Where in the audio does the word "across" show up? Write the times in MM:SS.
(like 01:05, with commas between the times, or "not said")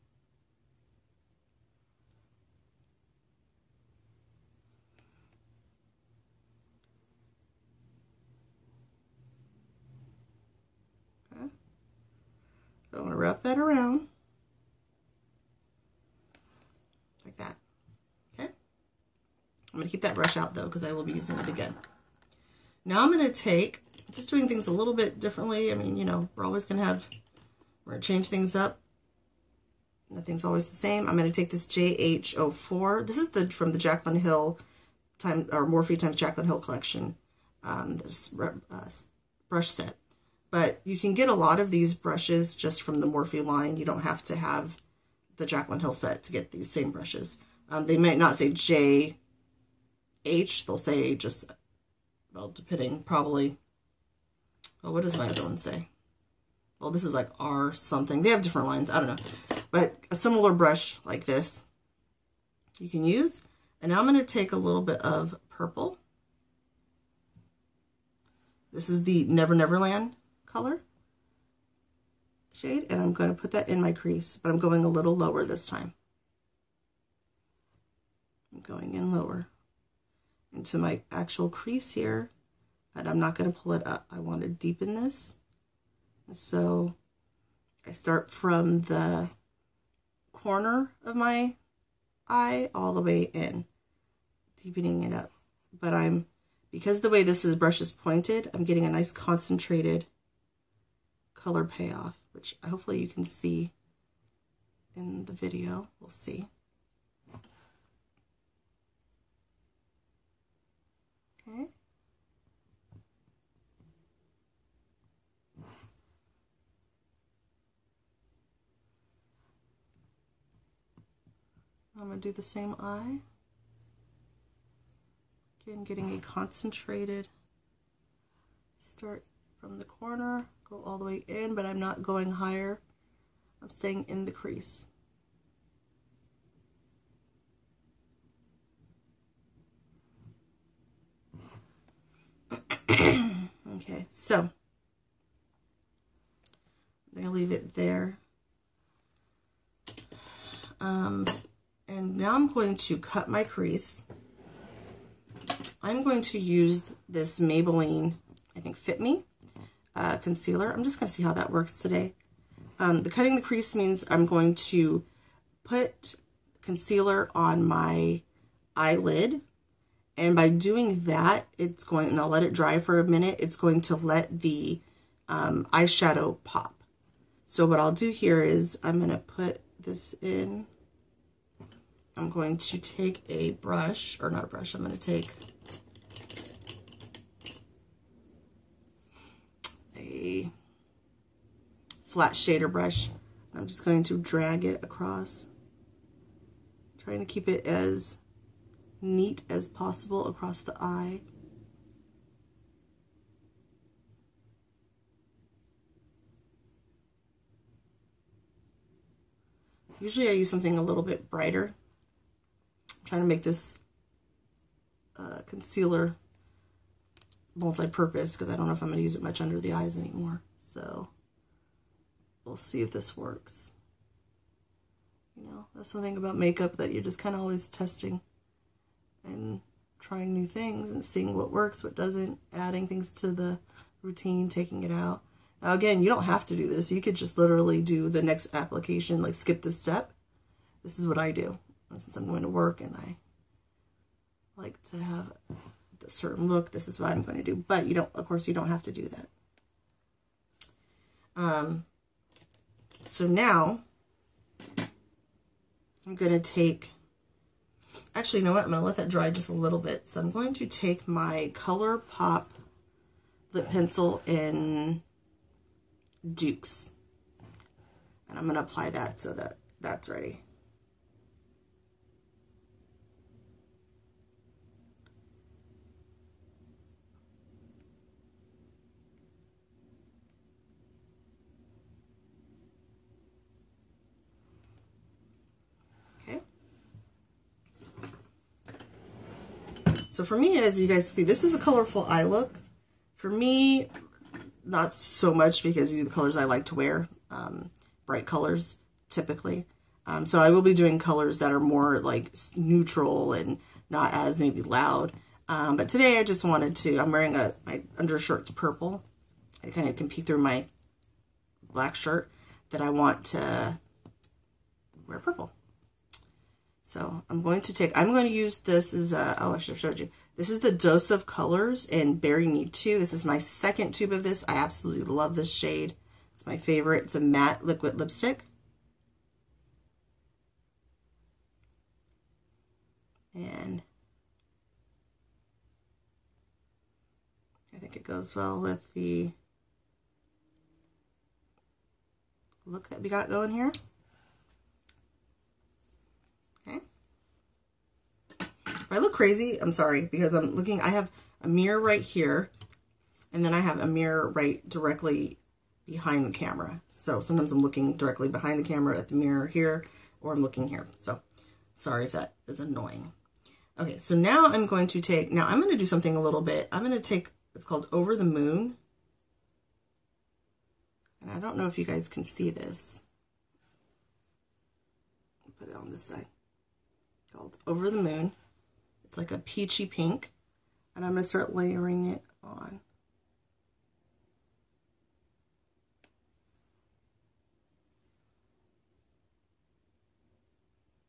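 03:14, 03:20.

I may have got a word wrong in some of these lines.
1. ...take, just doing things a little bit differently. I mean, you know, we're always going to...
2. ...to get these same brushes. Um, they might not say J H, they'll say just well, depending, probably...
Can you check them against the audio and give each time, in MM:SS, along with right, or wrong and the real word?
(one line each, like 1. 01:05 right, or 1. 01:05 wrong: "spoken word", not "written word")
1. 00:23 right
2. 00:46 right.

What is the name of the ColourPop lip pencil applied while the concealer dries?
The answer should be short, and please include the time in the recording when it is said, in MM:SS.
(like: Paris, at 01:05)
Dukes, at 04:26.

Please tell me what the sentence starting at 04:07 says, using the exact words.
But you don't, of course, you don't have to do that.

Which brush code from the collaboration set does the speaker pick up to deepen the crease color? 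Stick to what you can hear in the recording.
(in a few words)
JH04.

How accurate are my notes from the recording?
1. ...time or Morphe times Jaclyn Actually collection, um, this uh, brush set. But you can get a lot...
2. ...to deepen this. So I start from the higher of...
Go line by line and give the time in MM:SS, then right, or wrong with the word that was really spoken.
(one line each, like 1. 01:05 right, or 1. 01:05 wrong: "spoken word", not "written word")
1. 00:35 wrong: "Hill", not "Actually"
2. 01:24 wrong: "corner", not "higher".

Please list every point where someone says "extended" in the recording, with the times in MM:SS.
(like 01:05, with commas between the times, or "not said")
not said.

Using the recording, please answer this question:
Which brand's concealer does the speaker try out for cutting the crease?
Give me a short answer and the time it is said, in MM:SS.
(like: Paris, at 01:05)
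Maybelline, at 02:37.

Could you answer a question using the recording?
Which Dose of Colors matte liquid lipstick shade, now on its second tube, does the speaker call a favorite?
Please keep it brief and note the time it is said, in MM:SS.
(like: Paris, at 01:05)
Berry Me, at 05:22.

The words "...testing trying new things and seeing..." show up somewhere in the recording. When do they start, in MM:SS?
03:47.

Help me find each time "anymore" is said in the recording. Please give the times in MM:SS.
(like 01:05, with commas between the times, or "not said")
03:39.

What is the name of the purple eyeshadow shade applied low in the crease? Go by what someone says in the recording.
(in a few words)
Never Never Land.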